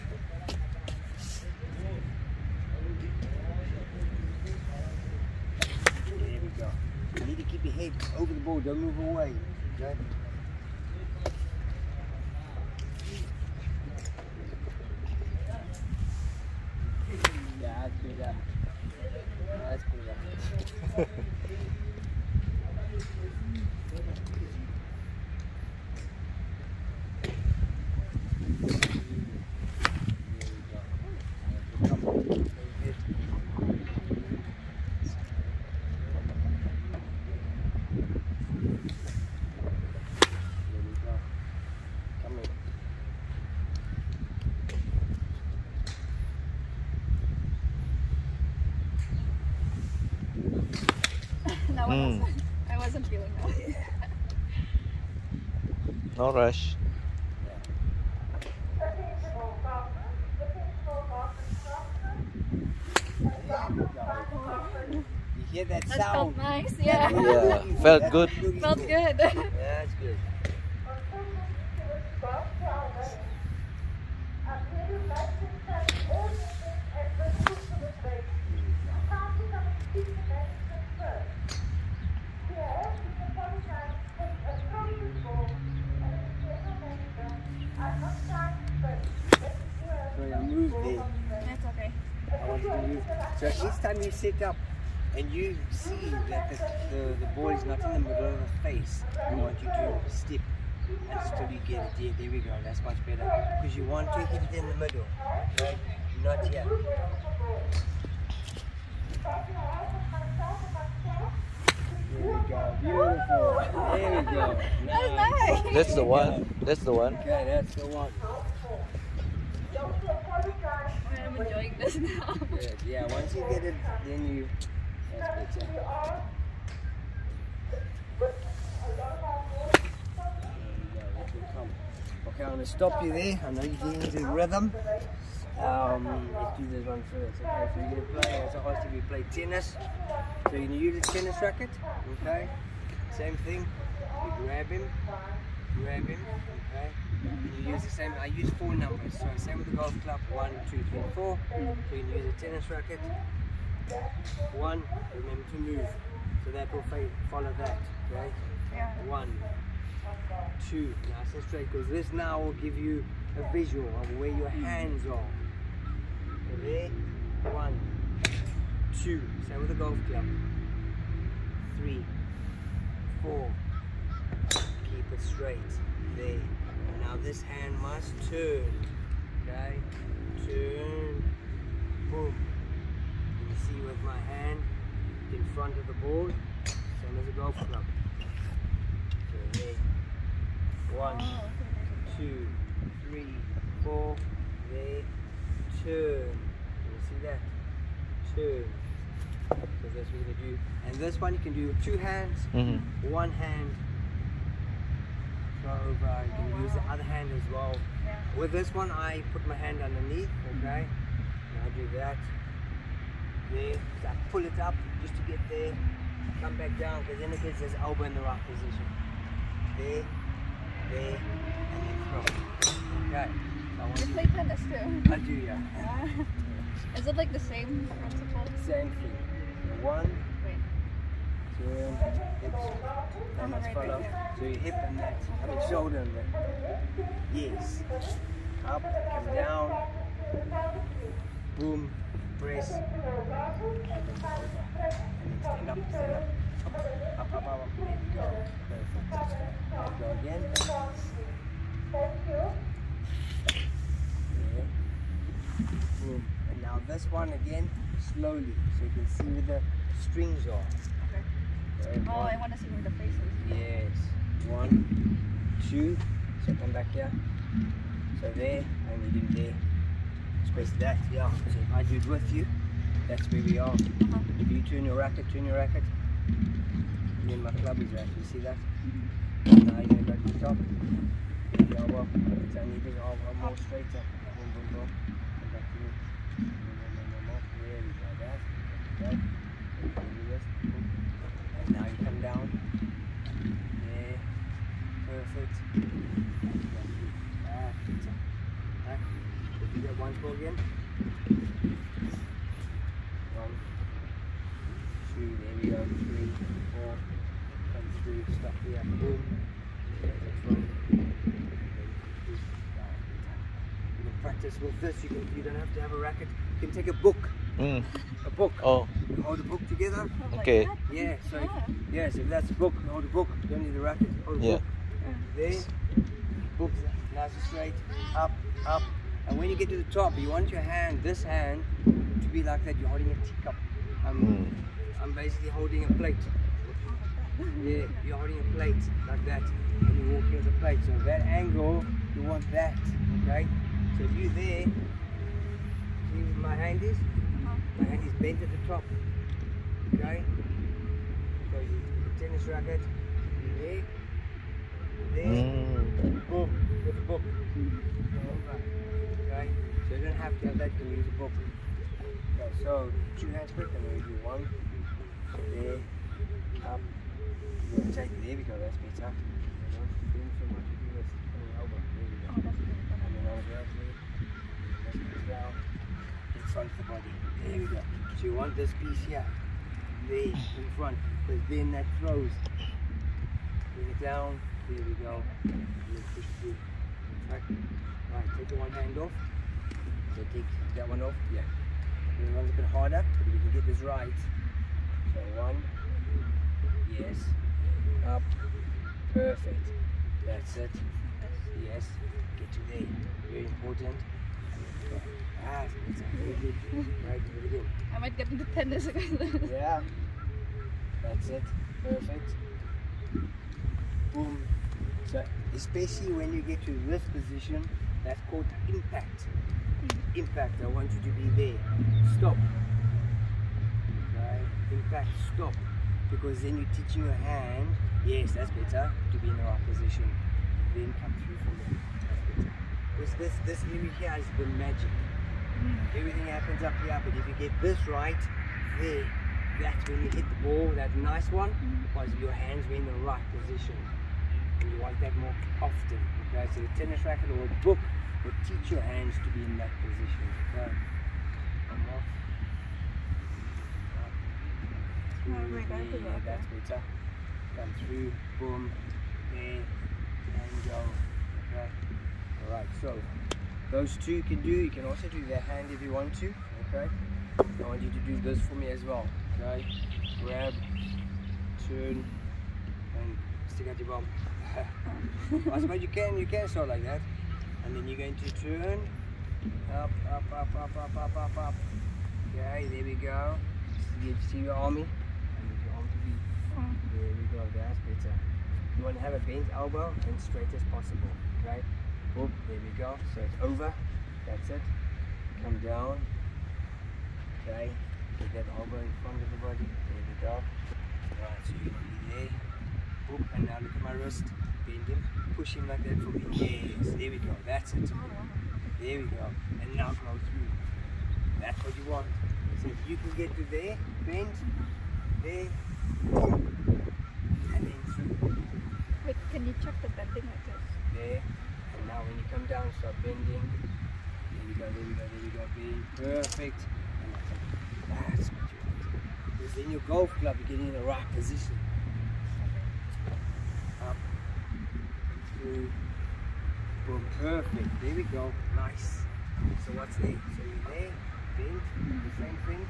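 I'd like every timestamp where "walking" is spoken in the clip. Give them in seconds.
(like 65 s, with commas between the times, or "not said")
340 s.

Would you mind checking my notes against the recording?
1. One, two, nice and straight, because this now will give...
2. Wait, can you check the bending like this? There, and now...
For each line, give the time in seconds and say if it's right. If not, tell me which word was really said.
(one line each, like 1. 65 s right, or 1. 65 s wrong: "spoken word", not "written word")
1. 159 s right
2. 519 s right.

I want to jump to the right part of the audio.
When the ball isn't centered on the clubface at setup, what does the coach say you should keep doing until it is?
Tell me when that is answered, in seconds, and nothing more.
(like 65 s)
100 s.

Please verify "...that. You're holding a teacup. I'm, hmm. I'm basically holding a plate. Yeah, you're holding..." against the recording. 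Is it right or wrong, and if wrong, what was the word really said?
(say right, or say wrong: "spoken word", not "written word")
right.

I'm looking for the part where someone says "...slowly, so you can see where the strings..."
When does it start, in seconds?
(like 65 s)
258 s.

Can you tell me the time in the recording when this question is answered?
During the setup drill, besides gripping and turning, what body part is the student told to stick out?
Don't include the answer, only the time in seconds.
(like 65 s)
473 s.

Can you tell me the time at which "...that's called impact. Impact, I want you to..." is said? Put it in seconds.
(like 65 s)
418 s.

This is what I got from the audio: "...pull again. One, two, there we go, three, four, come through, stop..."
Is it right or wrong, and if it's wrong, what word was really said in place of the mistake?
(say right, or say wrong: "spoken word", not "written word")
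right.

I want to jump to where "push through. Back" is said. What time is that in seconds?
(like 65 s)
386 s.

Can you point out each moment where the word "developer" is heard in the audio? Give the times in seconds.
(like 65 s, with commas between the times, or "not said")
not said.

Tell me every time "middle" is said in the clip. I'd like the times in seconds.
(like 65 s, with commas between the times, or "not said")
97 s, 104 s.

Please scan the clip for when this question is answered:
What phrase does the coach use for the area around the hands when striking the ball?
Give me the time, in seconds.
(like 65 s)
434 s.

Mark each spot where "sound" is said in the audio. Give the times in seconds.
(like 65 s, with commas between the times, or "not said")
65 s.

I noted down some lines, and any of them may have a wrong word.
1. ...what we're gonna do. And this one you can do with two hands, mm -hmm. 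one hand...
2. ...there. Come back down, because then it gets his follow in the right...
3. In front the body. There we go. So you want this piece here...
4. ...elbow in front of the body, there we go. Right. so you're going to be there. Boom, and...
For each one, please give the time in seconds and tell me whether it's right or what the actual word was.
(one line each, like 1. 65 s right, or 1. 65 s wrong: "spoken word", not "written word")
1. 200 s right
2. 215 s wrong: "elbow", not "follow"
3. 370 s right
4. 498 s right.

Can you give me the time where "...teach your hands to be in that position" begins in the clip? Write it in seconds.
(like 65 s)
448 s.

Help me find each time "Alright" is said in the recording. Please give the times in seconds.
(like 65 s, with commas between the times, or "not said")
297 s, 462 s.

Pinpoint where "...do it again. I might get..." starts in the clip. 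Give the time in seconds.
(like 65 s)
407 s.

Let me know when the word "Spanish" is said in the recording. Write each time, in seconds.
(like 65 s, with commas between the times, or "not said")
not said.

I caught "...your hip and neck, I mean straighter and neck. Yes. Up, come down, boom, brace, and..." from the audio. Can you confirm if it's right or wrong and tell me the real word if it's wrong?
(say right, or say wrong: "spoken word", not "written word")
wrong: "shoulder", not "straighter".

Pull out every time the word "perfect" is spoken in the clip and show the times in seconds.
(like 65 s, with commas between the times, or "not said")
249 s, 295 s, 399 s, 411 s, 526 s, 537 s.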